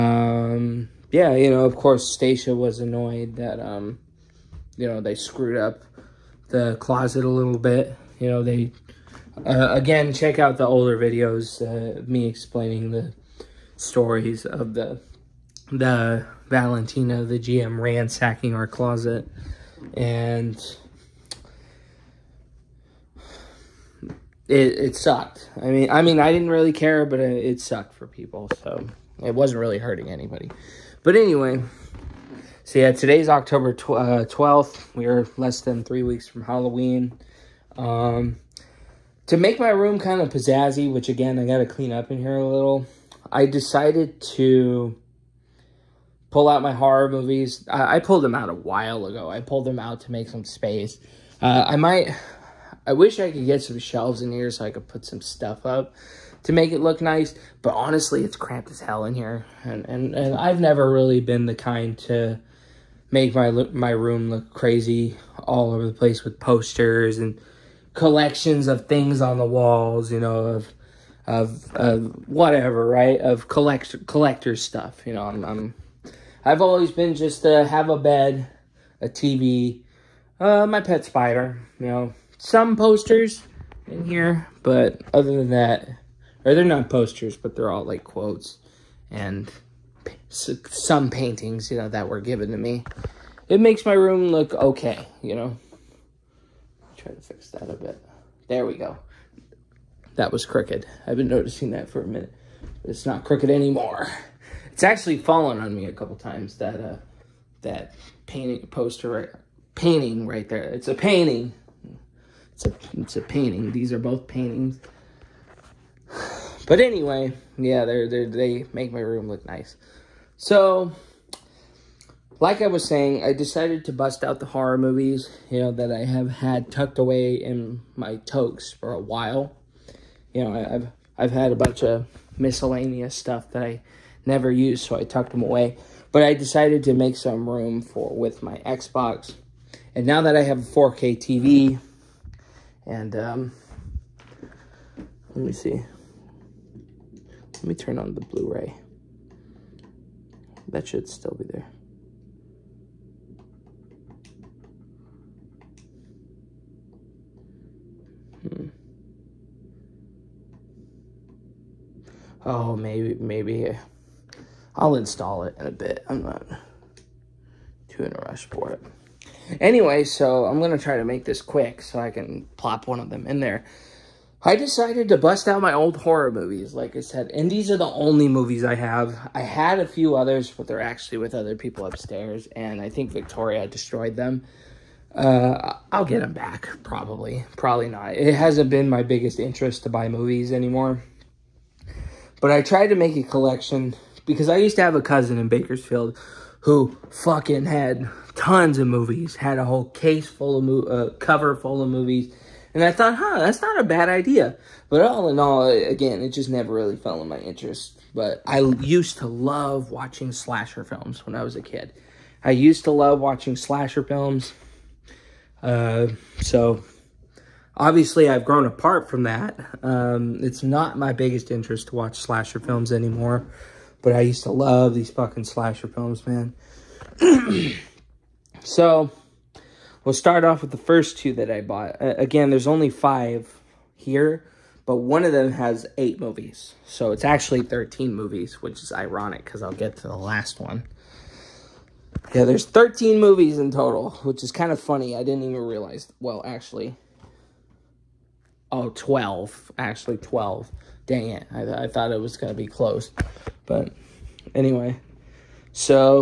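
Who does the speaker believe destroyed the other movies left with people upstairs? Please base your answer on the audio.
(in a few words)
Victoria.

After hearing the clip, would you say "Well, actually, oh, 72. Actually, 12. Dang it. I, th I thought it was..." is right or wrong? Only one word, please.
wrong.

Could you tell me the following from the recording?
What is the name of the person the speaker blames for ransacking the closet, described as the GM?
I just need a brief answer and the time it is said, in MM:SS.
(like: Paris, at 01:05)
Valentina, at 00:16.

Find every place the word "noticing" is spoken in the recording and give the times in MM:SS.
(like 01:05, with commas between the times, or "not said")
01:41.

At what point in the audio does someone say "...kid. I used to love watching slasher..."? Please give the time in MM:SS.
03:31.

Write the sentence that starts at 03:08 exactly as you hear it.
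It hasn't been my biggest interest to buy movies anymore.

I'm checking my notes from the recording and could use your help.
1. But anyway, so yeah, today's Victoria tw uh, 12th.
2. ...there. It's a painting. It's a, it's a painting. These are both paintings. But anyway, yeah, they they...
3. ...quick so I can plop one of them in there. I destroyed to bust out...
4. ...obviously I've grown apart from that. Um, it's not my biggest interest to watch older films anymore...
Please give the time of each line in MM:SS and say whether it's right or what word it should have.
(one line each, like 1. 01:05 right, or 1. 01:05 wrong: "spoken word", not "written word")
1. 00:31 wrong: "October", not "Victoria"
2. 01:50 right
3. 02:51 wrong: "decided", not "destroyed"
4. 03:37 wrong: "slasher", not "older".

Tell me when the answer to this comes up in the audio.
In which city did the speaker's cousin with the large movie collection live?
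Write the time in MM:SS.
03:15.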